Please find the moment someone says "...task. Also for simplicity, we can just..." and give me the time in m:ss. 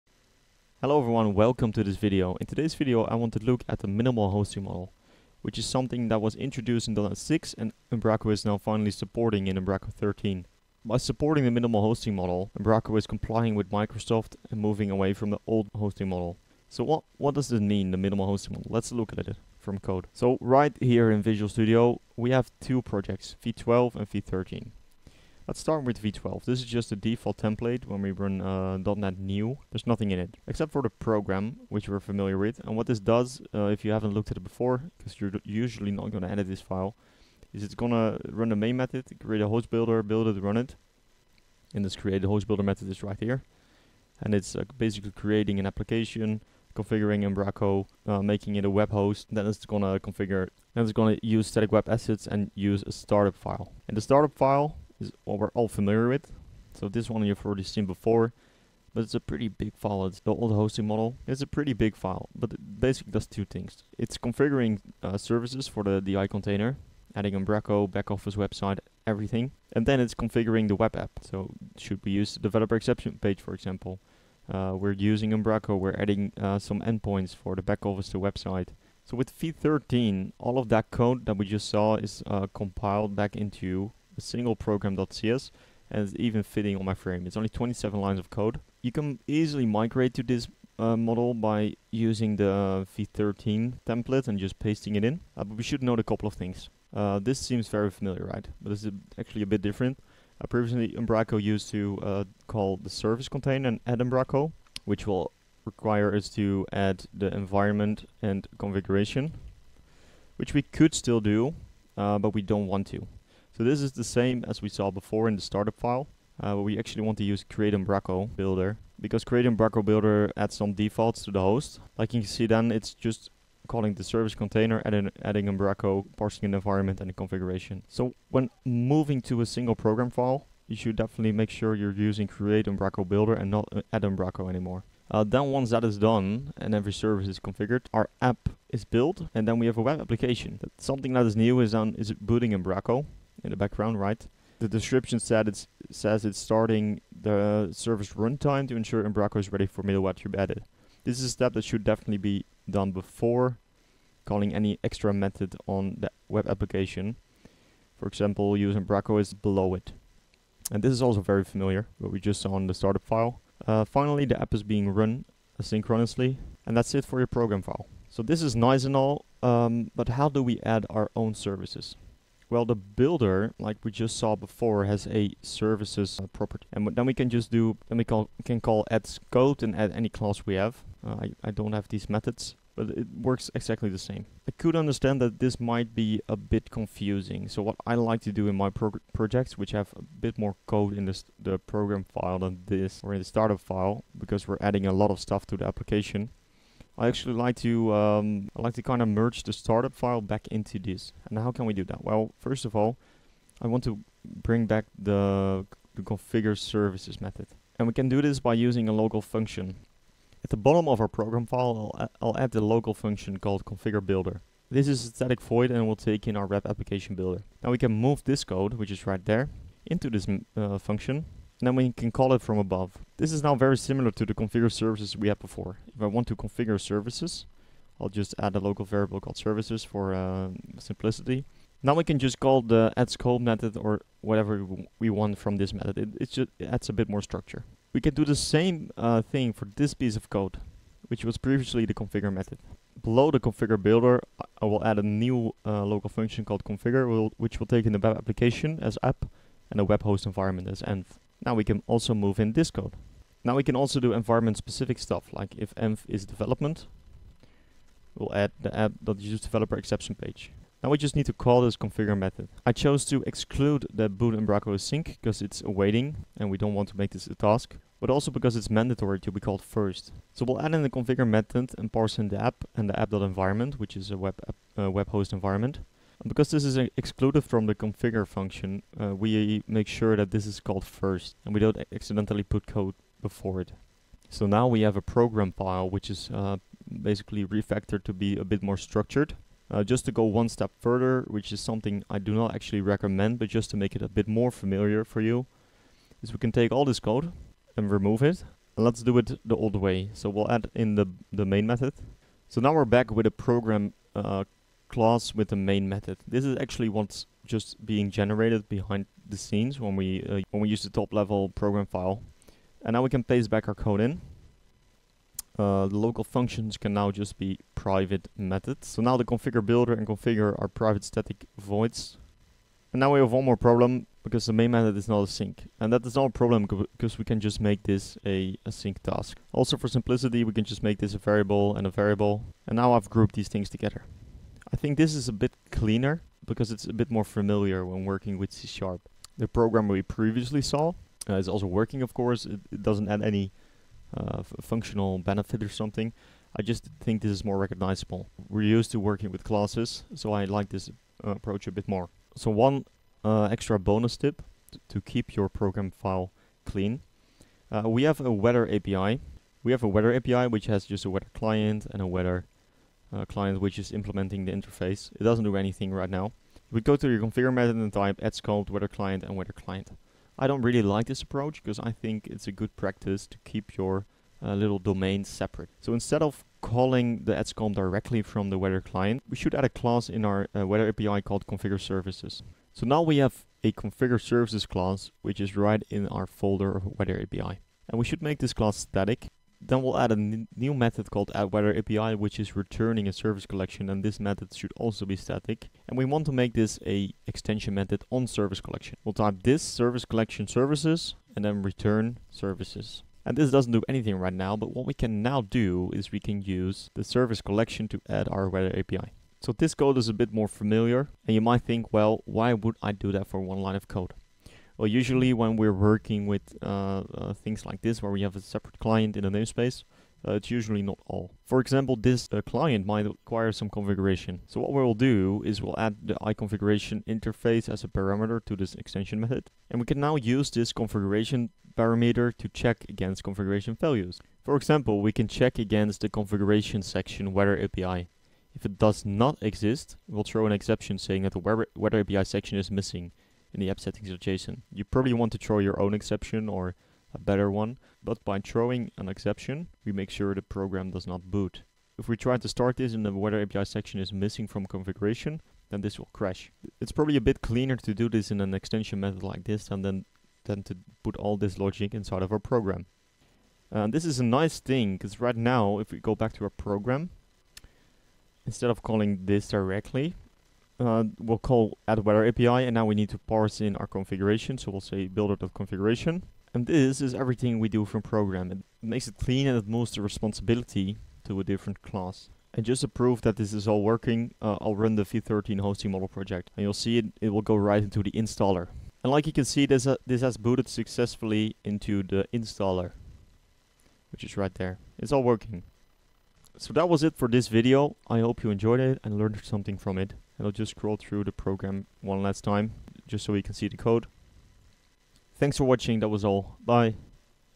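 5:28.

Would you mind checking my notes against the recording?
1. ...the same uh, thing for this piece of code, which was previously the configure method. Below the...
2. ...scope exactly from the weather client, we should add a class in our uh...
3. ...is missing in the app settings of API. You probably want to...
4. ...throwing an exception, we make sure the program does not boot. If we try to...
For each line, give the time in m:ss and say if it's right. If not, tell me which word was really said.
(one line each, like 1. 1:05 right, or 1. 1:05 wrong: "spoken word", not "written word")
1. 3:58 right
2. 6:17 wrong: "directly", not "exactly"
3. 7:22 wrong: "JSON", not "API"
4. 7:28 right.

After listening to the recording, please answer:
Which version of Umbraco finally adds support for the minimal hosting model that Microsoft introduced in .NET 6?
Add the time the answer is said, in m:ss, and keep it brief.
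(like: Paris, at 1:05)
Umbraco 13, at 0:09.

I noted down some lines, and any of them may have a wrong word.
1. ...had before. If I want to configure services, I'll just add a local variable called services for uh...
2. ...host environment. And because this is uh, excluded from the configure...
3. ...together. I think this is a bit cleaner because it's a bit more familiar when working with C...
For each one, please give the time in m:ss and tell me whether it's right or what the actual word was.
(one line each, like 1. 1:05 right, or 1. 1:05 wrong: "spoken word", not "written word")
1. 3:45 right
2. 4:35 right
3. 5:33 right.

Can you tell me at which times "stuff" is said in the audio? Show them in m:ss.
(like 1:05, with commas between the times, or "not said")
3:15, 4:14.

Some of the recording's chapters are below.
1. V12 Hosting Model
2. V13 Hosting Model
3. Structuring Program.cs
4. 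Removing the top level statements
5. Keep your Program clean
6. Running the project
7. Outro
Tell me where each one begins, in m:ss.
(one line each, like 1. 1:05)
1. 0:21
2. 1:18
3. 3:14
4. 4:48
5. 5:51
6. 8:08
7. 8:22.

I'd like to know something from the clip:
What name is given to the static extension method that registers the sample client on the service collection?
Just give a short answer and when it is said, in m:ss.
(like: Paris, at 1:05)
AddWeatherAPI, at 6:31.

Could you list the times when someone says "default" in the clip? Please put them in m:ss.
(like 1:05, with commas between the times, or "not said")
0:26, 2:00.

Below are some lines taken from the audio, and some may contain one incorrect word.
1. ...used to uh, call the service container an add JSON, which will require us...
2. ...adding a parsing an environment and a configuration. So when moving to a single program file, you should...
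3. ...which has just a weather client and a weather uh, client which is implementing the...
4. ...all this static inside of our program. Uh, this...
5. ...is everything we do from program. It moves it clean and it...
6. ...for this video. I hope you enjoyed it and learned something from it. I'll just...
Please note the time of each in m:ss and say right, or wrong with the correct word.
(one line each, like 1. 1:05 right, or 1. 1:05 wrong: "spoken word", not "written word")
1. 1:41 wrong: "Umbraco", not "JSON"
2. 2:05 right
3. 6:00 right
4. 7:41 wrong: "logic", not "static"
5. 7:57 wrong: "makes", not "moves"
6. 8:17 right.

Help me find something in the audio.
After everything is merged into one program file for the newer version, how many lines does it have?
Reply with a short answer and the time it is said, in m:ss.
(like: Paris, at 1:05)
27, at 1:27.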